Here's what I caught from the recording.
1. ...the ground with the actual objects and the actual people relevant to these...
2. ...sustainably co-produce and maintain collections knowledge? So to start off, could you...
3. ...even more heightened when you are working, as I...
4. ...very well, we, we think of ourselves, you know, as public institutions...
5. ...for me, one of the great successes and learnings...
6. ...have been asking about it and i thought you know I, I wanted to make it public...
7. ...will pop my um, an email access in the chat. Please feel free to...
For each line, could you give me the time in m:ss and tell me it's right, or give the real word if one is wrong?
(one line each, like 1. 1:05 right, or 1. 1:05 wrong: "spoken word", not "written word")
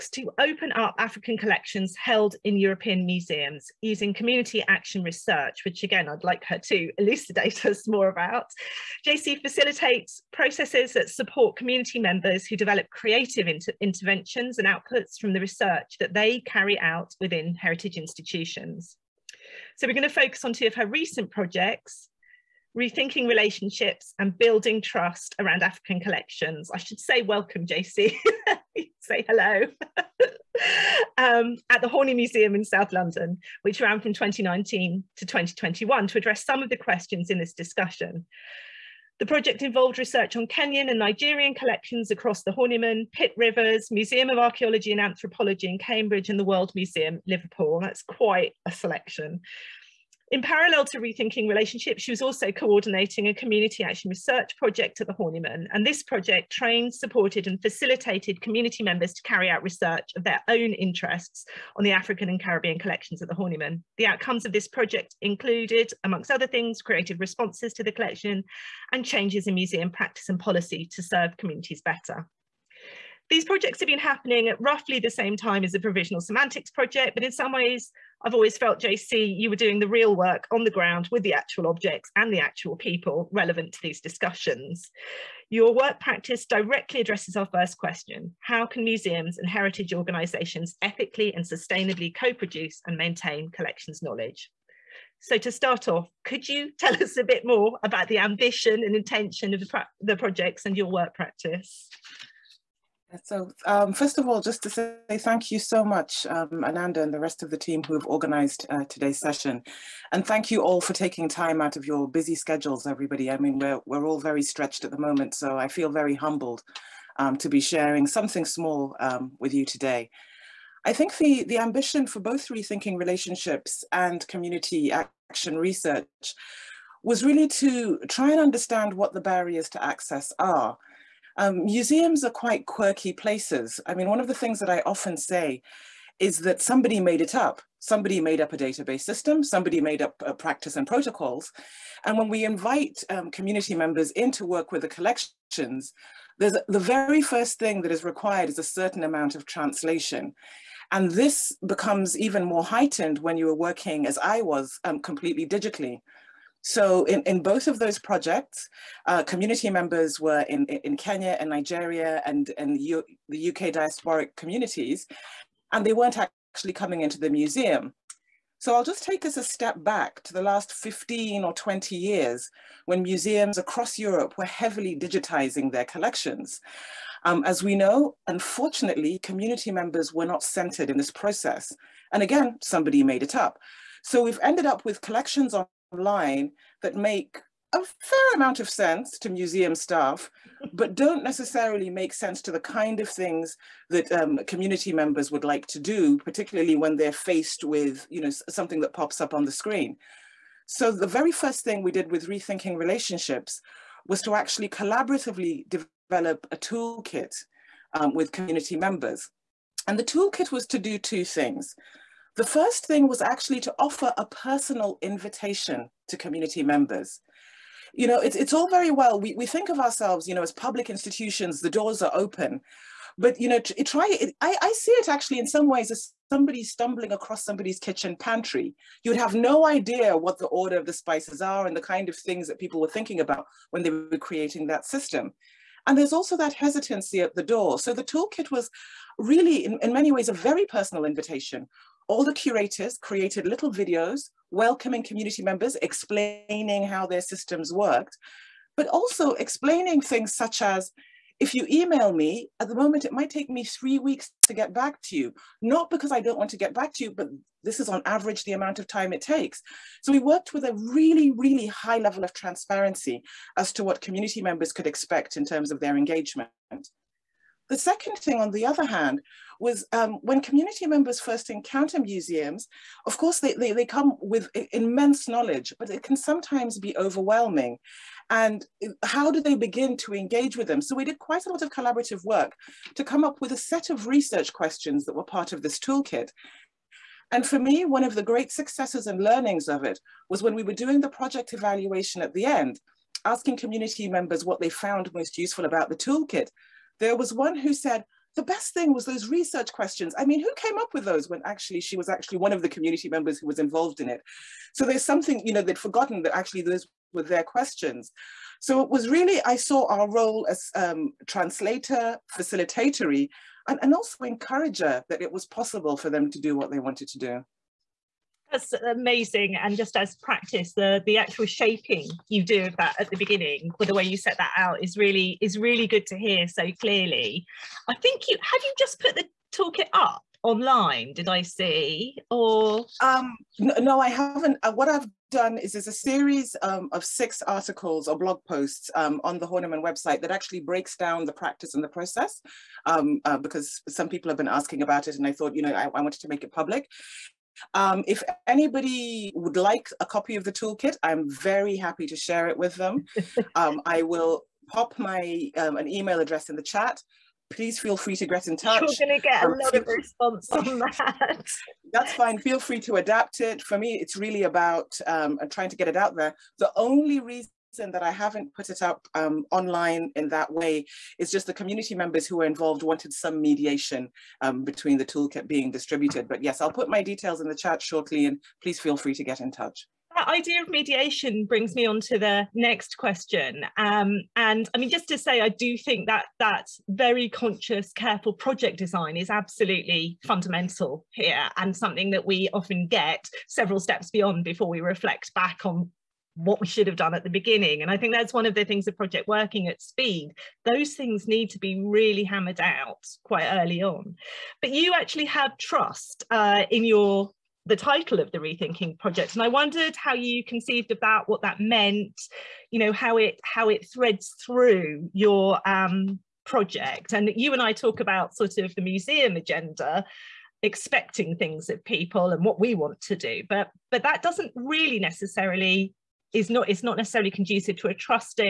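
1. 1:20 right
2. 1:31 right
3. 2:32 right
4. 3:38 right
5. 4:47 right
6. 5:44 right
7. 5:54 wrong: "address", not "access".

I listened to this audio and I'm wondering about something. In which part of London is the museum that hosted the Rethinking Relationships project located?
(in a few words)
South London.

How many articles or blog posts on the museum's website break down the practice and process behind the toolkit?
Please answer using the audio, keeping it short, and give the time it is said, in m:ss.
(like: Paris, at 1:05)
6, at 5:37.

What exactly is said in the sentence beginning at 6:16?
But yes, I'll put my details in the chat shortly and please feel free to get in touch.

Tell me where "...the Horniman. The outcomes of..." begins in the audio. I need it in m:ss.
1:03.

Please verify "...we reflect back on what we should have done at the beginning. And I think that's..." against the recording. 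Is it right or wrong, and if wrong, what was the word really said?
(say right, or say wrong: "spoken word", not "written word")
right.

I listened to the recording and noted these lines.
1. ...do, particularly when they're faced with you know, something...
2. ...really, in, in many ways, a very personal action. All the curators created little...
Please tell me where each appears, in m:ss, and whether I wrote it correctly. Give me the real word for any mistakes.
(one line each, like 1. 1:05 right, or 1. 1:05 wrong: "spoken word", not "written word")
1. 3:15 right
2. 3:59 wrong: "invitation", not "action".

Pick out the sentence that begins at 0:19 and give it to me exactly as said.
So we're going to focus on two of her recent projects, rethinking relationships and building trust around African collections.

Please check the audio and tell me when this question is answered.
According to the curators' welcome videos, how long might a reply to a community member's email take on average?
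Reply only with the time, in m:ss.
4:13.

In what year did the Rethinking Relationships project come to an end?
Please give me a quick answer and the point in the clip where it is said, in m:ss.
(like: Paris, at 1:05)
2021, at 0:35.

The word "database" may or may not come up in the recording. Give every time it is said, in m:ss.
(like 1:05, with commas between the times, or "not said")
2:18.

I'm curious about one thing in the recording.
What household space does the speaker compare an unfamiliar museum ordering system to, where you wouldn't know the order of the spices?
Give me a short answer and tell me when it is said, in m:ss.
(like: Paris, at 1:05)
kitchen pantry, at 3:47.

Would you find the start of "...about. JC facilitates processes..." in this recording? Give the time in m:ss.
0:08.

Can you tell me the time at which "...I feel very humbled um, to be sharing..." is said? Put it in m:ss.
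1:55.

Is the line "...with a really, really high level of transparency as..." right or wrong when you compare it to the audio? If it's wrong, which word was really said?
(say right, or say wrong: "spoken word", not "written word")
right.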